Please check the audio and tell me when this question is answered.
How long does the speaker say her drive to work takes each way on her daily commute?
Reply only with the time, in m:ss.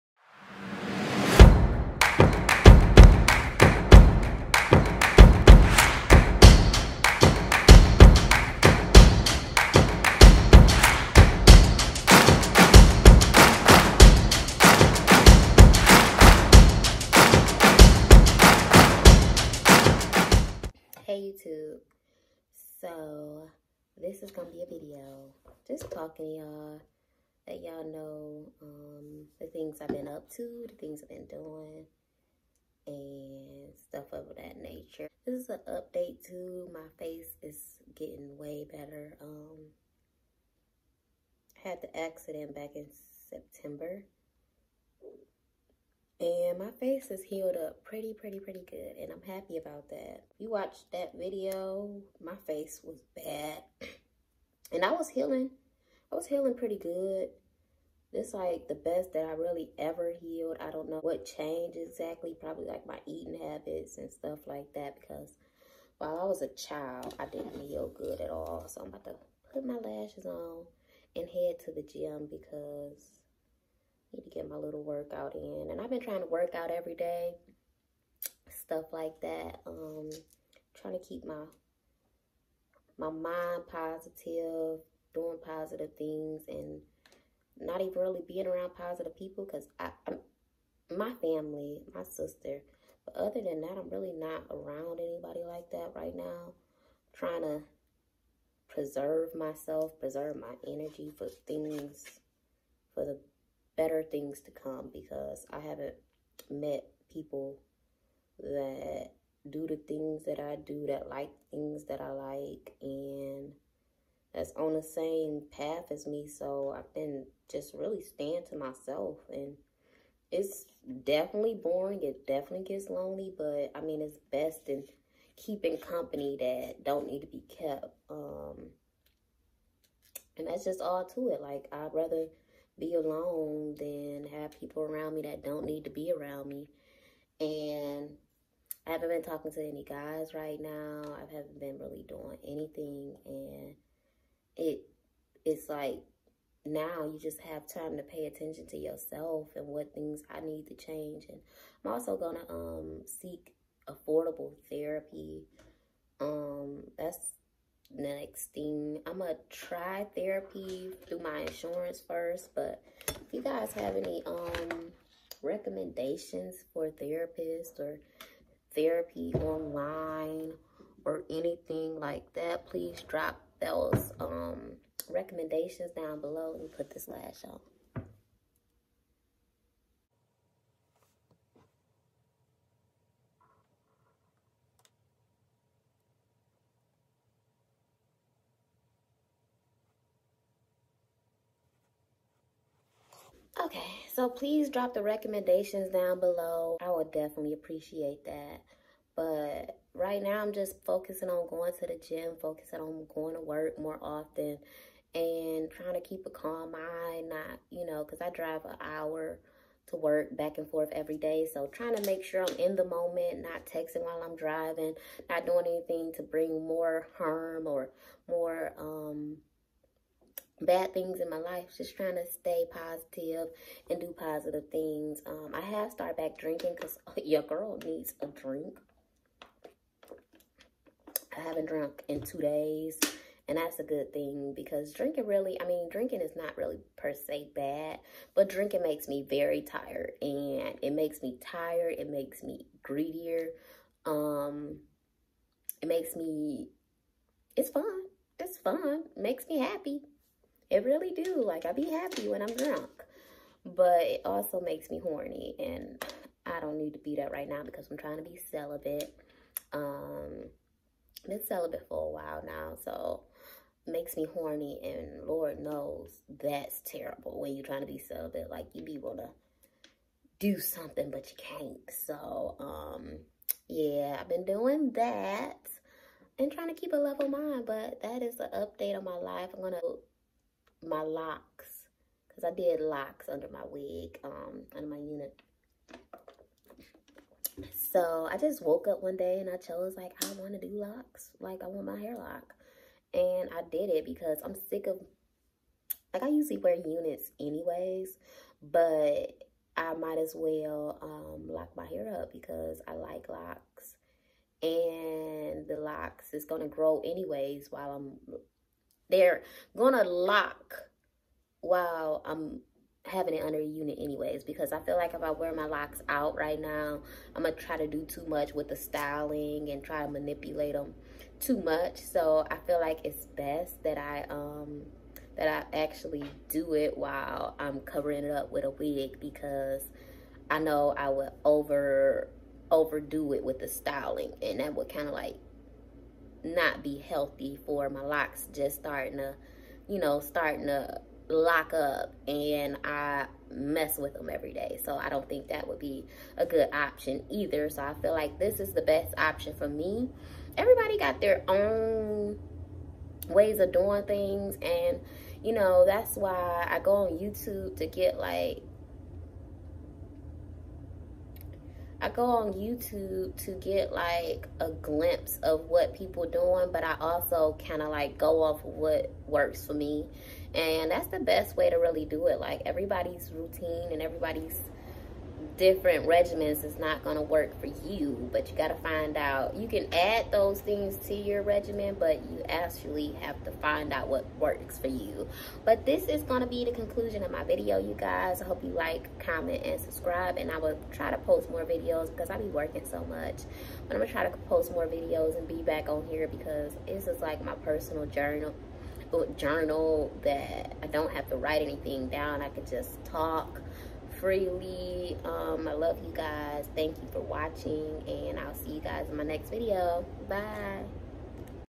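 3:28.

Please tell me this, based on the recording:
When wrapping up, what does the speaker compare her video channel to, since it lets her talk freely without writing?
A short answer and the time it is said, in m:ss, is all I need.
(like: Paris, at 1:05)
personal journal, at 6:37.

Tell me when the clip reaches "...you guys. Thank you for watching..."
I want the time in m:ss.
6:46.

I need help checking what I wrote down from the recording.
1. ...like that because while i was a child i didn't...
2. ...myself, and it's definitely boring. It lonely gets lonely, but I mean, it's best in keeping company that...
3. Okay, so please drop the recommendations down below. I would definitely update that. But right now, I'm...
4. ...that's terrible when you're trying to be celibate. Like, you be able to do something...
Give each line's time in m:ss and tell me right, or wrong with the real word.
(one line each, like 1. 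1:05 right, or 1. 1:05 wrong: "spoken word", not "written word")
1. 1:04 right
2. 1:58 wrong: "definitely", not "lonely"
3. 3:13 wrong: "appreciate", not "update"
4. 4:26 right.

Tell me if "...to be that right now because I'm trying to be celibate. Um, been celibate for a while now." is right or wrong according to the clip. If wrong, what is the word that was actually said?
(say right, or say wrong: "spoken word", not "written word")
right.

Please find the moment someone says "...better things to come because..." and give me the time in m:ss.
1:43.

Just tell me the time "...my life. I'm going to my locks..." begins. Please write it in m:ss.
4:39.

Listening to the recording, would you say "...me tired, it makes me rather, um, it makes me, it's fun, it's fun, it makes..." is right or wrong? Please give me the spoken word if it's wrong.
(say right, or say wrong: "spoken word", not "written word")
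wrong: "greedier", not "rather".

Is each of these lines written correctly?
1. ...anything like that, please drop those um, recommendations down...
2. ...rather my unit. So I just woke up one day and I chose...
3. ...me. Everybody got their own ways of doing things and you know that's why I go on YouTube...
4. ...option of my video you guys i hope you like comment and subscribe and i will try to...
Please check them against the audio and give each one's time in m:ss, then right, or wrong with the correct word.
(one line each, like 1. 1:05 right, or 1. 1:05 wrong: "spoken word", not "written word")
1. 2:51 right
2. 4:44 wrong: "under", not "rather"
3. 5:49 right
4. 6:26 wrong: "conclusion", not "option".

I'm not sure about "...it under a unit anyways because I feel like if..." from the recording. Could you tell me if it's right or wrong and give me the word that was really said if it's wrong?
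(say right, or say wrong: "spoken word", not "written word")
right.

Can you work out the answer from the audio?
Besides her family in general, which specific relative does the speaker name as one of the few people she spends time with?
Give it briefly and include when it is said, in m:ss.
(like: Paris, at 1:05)
my sister, at 1:31.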